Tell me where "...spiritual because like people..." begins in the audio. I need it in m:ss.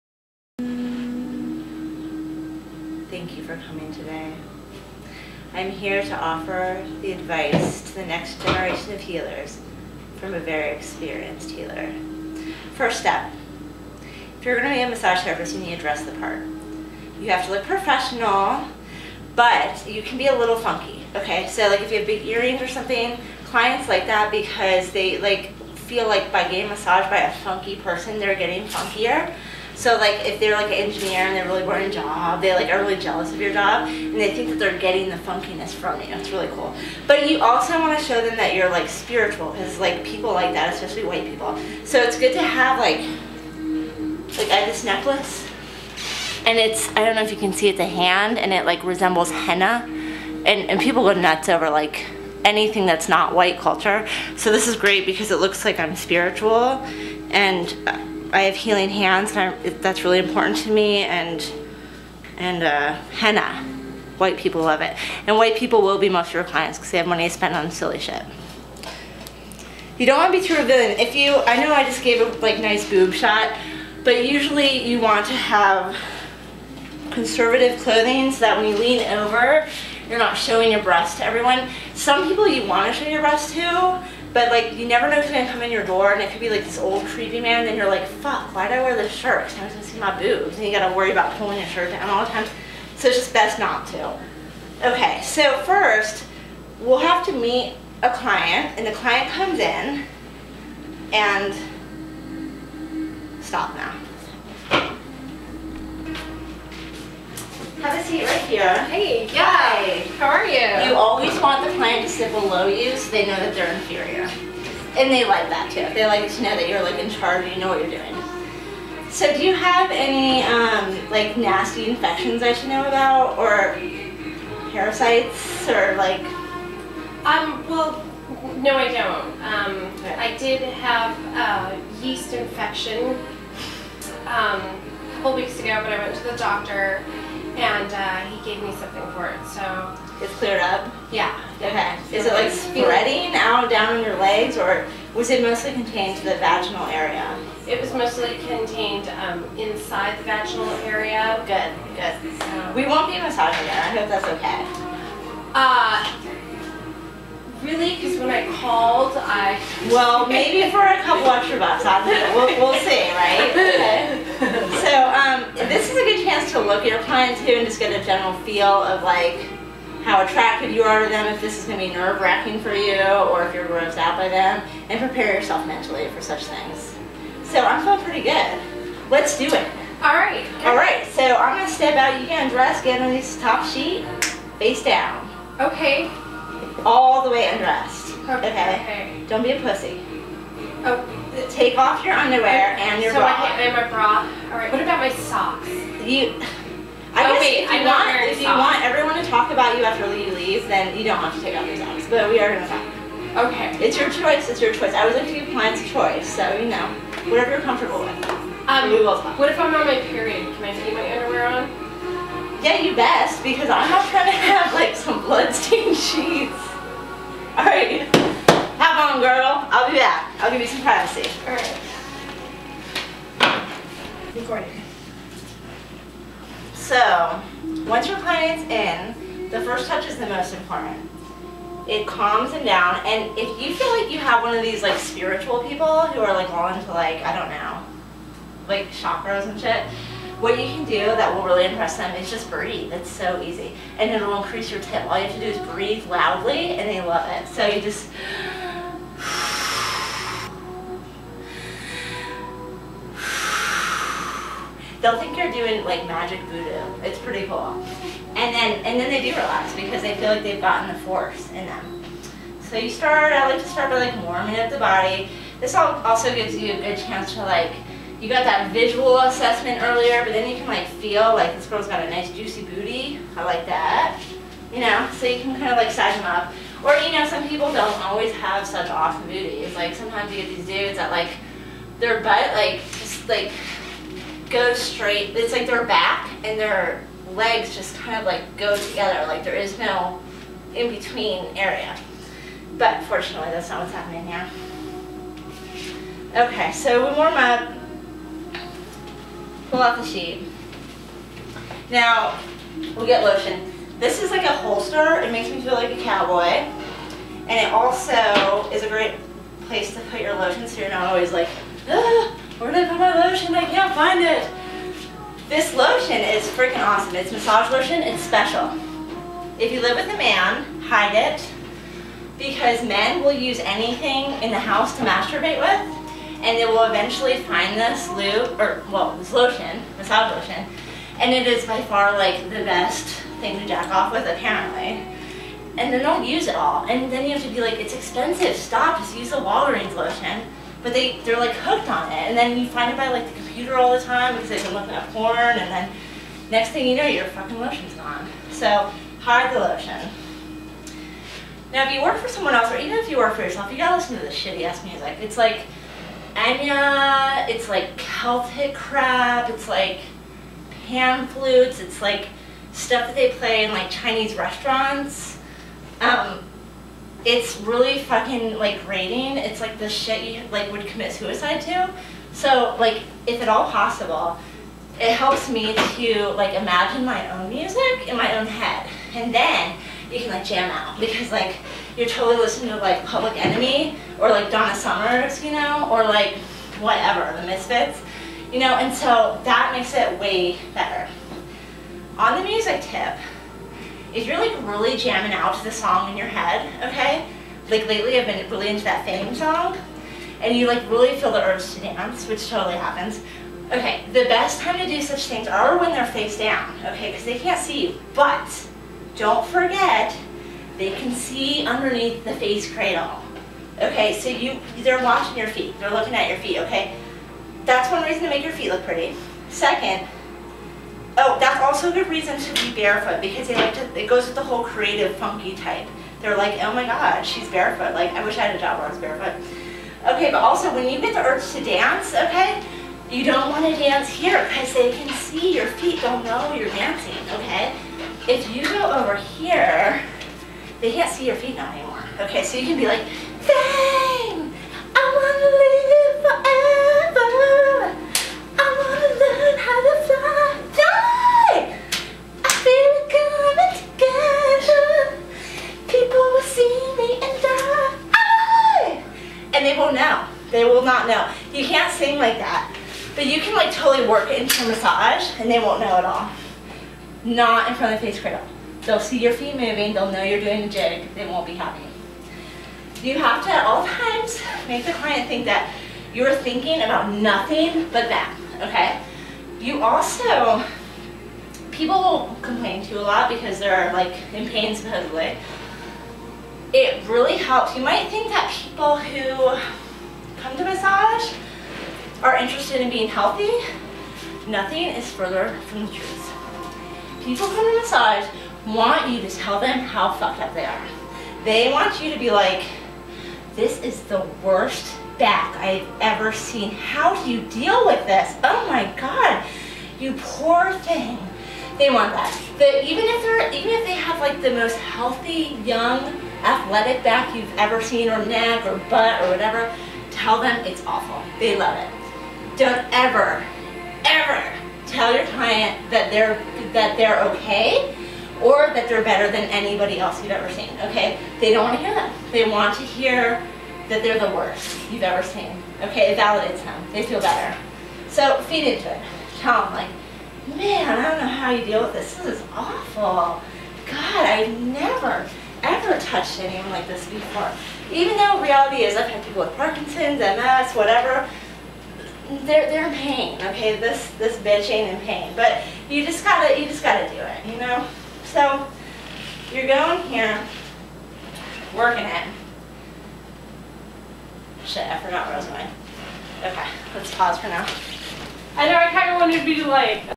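0:38.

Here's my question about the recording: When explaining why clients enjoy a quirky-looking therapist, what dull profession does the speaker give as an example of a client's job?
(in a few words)
engineer.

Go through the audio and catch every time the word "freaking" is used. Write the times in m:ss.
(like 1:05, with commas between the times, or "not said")
5:16.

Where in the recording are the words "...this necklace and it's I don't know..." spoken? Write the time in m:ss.
0:44.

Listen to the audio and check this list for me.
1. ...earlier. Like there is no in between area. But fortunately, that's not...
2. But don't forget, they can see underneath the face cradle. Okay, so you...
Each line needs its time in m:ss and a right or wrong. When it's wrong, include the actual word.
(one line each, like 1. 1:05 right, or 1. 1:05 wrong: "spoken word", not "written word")
1. 4:48 wrong: "together", not "earlier"
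2. 6:48 right.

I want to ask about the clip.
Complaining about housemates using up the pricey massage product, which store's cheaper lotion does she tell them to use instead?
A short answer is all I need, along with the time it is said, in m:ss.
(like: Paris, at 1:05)
Walgreens, at 5:39.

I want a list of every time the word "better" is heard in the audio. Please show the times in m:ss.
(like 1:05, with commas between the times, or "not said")
6:30, 8:49, 8:57.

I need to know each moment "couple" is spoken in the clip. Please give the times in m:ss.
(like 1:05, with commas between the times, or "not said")
2:15, 2:41.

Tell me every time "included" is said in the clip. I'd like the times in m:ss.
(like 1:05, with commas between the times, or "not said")
not said.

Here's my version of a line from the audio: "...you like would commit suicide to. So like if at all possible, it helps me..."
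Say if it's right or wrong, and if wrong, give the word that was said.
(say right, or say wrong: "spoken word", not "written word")
right.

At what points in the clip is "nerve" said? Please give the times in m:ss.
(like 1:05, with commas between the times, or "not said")
2:51.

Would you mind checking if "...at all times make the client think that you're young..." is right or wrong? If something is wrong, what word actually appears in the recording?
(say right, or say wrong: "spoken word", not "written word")
wrong: "thinking", not "young".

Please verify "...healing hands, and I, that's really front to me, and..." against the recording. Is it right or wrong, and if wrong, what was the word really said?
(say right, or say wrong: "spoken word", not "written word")
wrong: "important", not "front".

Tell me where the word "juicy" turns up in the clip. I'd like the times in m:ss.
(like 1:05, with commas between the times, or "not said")
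4:32.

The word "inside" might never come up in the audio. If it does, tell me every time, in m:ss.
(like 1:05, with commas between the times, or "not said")
2:29.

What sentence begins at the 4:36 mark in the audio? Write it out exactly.
Or you know, some people don't always have such awesome booties.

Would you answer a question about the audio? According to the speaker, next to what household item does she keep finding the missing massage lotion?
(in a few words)
the computer.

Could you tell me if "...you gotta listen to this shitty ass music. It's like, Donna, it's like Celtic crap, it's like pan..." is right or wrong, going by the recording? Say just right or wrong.
wrong.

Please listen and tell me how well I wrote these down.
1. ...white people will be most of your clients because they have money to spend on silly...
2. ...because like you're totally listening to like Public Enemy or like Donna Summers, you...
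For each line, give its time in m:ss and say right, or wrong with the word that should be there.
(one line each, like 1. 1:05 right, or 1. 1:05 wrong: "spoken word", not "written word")
1. 1:05 right
2. 6:20 right.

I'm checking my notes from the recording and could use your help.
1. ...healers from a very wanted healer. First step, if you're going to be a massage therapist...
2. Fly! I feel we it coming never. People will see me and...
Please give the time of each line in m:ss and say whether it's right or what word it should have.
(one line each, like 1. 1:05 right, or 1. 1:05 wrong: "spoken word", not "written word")
1. 0:09 wrong: "experienced", not "wanted"
2. 7:30 wrong: "together", not "never".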